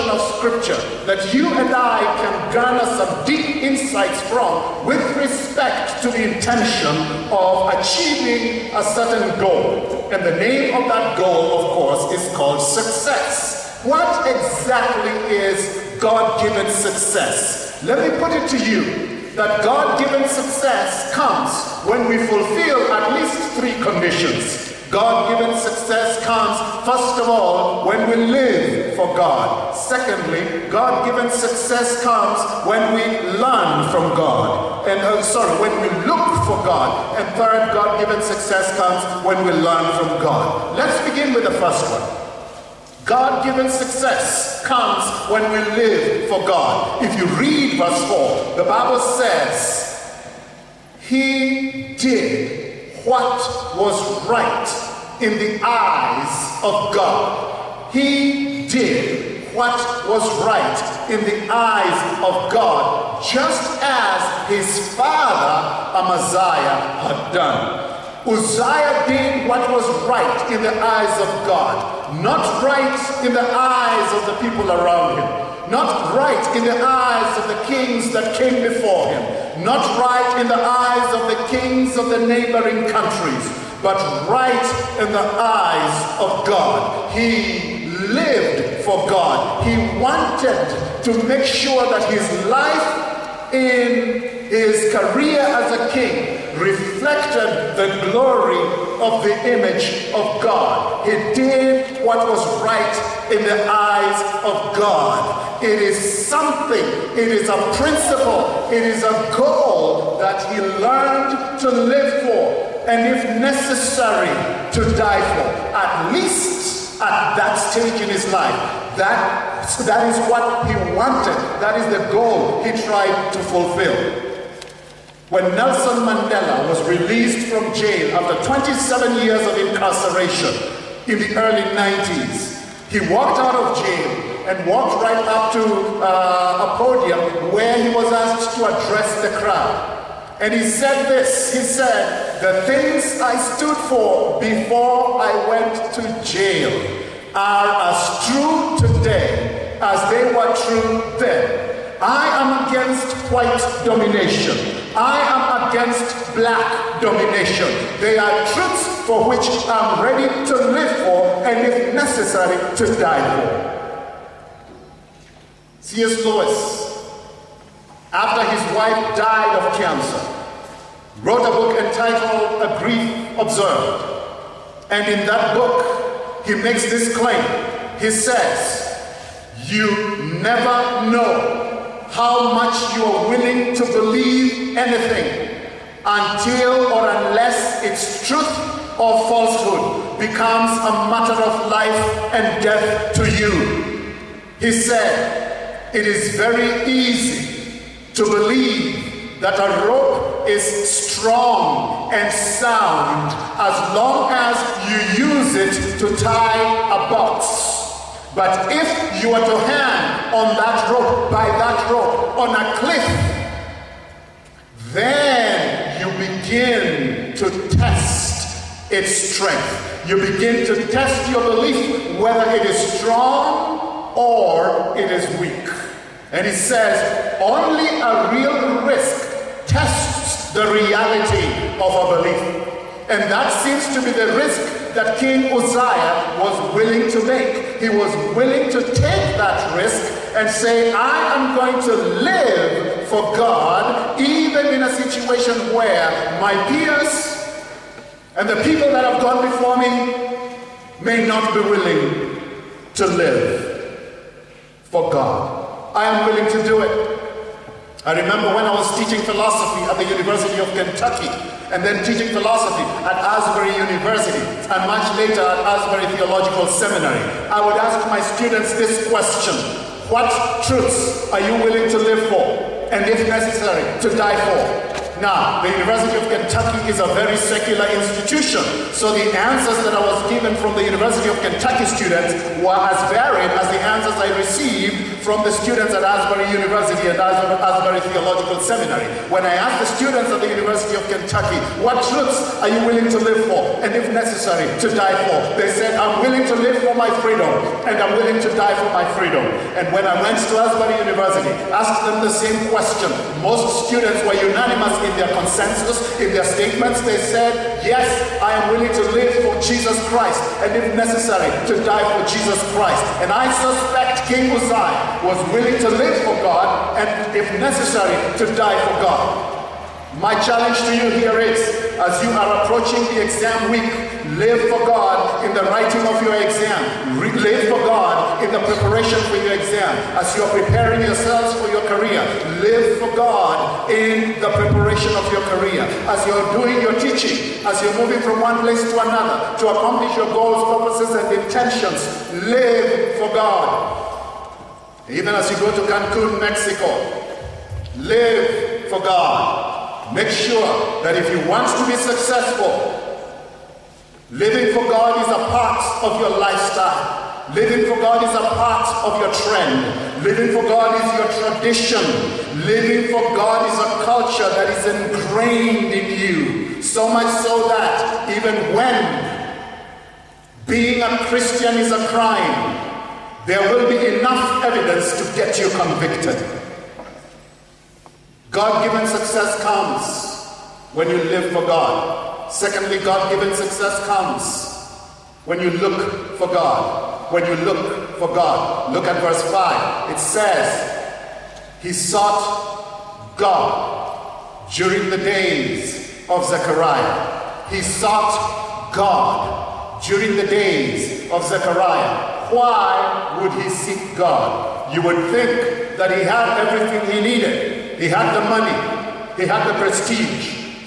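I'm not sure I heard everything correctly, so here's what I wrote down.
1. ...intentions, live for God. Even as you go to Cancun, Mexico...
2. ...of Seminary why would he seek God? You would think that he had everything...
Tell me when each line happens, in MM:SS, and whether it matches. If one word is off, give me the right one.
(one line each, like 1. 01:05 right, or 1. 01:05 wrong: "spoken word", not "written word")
1. 05:41 right
2. 06:41 wrong: "Zechariah", not "Seminary".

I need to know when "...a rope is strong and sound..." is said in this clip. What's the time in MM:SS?
03:19.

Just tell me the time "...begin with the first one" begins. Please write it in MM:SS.
00:41.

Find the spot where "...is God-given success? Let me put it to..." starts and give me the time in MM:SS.
00:15.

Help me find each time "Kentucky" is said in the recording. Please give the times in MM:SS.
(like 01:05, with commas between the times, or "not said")
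04:20, 04:36, 04:41, 04:51.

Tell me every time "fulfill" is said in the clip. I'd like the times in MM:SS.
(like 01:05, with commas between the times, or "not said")
00:22, 02:03.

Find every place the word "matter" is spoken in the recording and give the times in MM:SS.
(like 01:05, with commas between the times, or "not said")
03:11.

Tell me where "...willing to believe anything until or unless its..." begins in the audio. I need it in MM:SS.
03:03.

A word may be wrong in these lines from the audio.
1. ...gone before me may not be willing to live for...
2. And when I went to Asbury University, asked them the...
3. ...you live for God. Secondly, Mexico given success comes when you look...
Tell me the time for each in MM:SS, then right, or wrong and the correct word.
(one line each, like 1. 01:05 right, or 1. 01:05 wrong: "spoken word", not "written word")
1. 04:09 right
2. 04:59 right
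3. 06:21 wrong: "God", not "Mexico".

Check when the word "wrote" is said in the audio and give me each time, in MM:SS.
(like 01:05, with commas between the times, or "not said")
02:51.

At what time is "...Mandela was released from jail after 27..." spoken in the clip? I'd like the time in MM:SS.
02:06.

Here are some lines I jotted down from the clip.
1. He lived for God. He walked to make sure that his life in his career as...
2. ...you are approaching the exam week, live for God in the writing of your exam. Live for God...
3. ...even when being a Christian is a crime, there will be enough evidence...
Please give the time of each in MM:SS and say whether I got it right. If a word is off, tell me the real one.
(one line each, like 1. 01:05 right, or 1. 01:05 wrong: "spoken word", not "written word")
1. 01:27 wrong: "wanted", not "walked"
2. 05:22 right
3. 06:08 right.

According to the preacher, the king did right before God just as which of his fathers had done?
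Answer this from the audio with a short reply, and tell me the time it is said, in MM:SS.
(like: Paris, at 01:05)
Amaziah, at 01:05.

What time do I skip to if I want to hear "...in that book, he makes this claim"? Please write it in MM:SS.
02:55.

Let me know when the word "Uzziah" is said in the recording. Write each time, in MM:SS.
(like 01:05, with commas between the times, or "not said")
01:08, 03:55, 05:14.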